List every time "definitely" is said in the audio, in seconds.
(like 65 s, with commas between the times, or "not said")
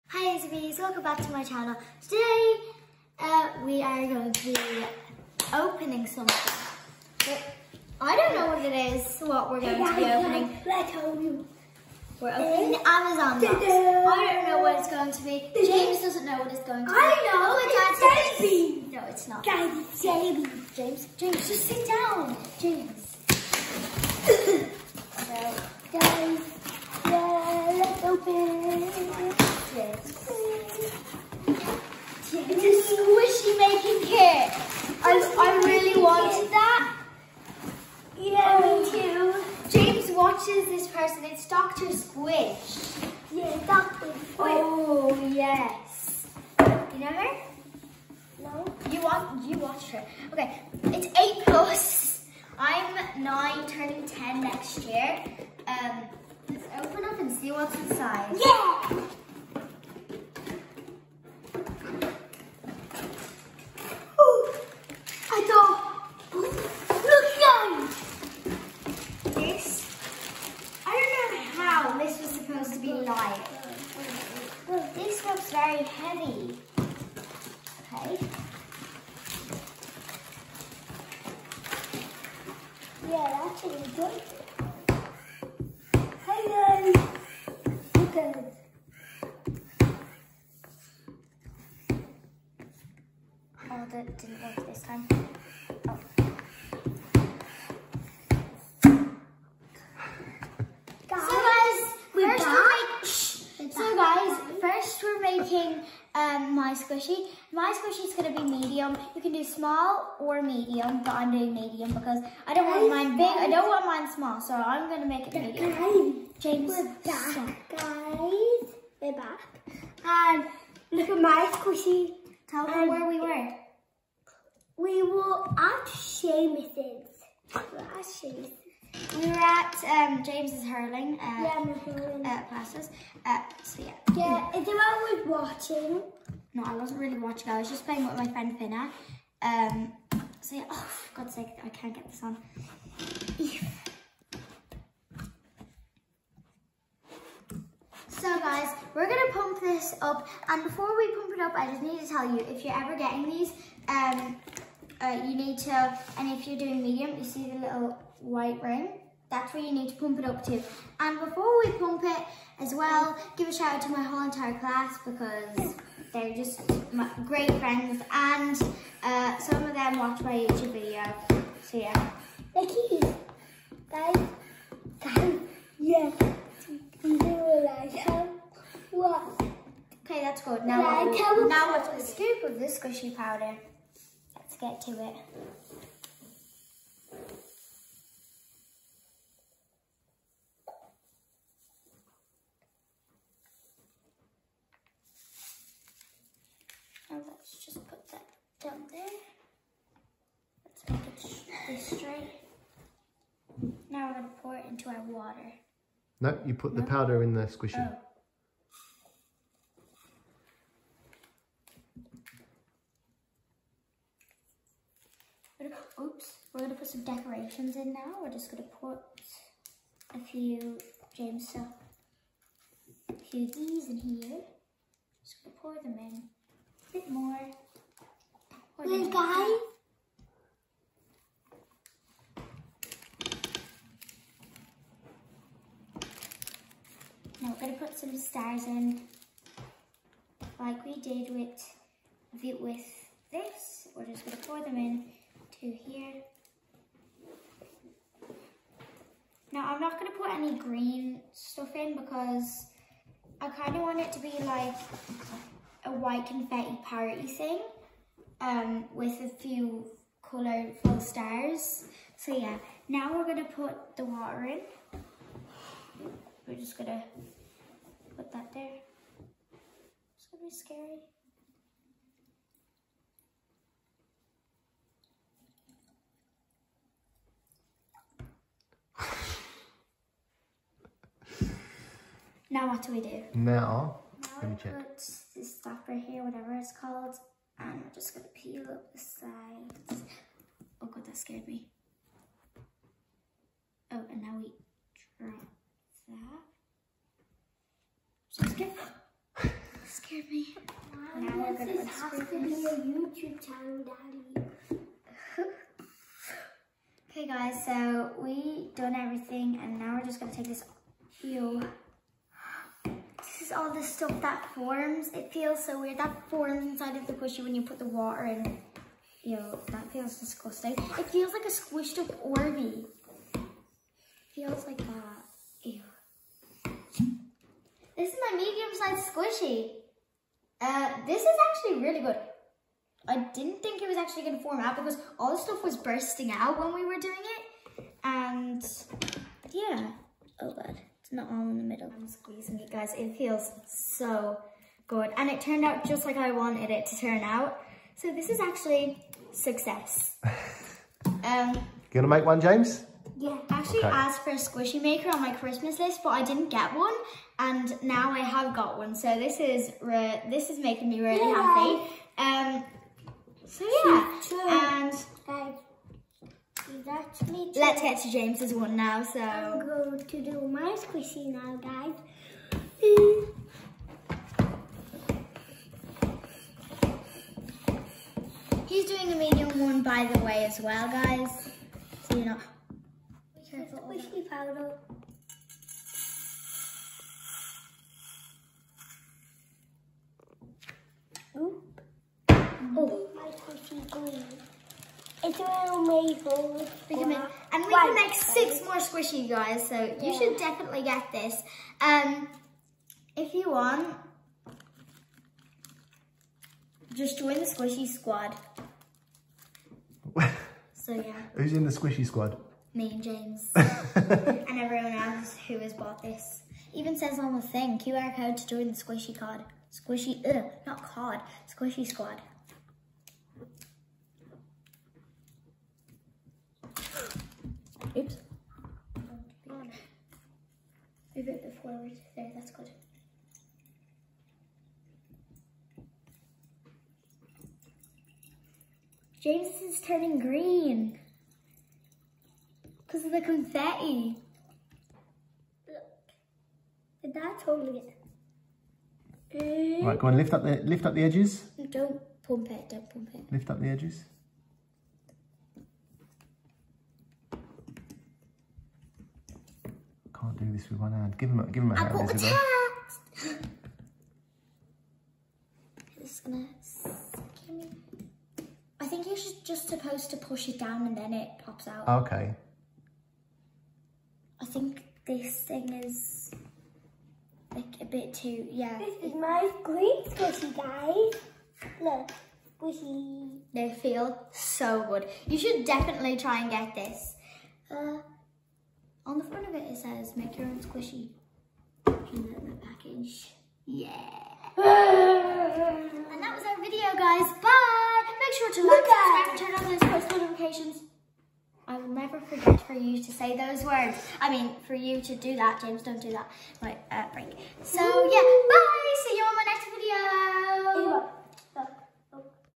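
400 s, 485 s.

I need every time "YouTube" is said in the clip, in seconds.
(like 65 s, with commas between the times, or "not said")
170 s, 302 s.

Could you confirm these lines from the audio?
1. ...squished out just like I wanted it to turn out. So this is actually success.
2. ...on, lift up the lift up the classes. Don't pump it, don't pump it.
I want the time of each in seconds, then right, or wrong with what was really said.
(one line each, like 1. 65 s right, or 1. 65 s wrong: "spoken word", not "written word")
1. 345 s wrong: "turned", not "squished"
2. 450 s wrong: "edges", not "classes".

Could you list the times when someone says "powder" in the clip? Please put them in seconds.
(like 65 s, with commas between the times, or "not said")
183 s, 206 s, 384 s.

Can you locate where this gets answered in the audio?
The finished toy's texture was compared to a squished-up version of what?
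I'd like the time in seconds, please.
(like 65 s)
321 s.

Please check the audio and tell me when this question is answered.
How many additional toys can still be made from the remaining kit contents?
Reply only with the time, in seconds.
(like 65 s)
398 s.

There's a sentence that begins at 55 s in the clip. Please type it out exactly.
Um, let's open up and see what's inside.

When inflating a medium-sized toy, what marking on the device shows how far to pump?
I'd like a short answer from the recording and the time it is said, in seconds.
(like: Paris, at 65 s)
Little white ring, at 157 s.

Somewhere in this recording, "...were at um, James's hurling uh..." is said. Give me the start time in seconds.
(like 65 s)
129 s.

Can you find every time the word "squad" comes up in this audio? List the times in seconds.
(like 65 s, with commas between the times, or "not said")
407 s, 412 s, 421 s.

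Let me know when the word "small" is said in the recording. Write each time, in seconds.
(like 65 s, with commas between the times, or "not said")
109 s, 114 s.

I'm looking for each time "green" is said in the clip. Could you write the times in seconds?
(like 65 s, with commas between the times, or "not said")
250 s, 393 s, 440 s, 479 s.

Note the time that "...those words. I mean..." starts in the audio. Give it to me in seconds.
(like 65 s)
503 s.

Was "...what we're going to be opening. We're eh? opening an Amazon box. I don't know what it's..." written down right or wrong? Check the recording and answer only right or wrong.
right.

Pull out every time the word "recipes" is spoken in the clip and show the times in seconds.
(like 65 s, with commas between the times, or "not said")
0 s.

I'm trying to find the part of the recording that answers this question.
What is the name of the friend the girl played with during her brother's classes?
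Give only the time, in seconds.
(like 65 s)
138 s.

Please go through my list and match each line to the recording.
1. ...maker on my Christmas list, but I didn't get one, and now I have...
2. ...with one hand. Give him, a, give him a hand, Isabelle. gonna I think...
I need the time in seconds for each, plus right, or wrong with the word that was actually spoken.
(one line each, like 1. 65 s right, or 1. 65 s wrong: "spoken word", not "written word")
1. 354 s right
2. 460 s right.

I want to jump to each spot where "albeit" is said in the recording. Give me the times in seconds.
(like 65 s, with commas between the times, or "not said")
not said.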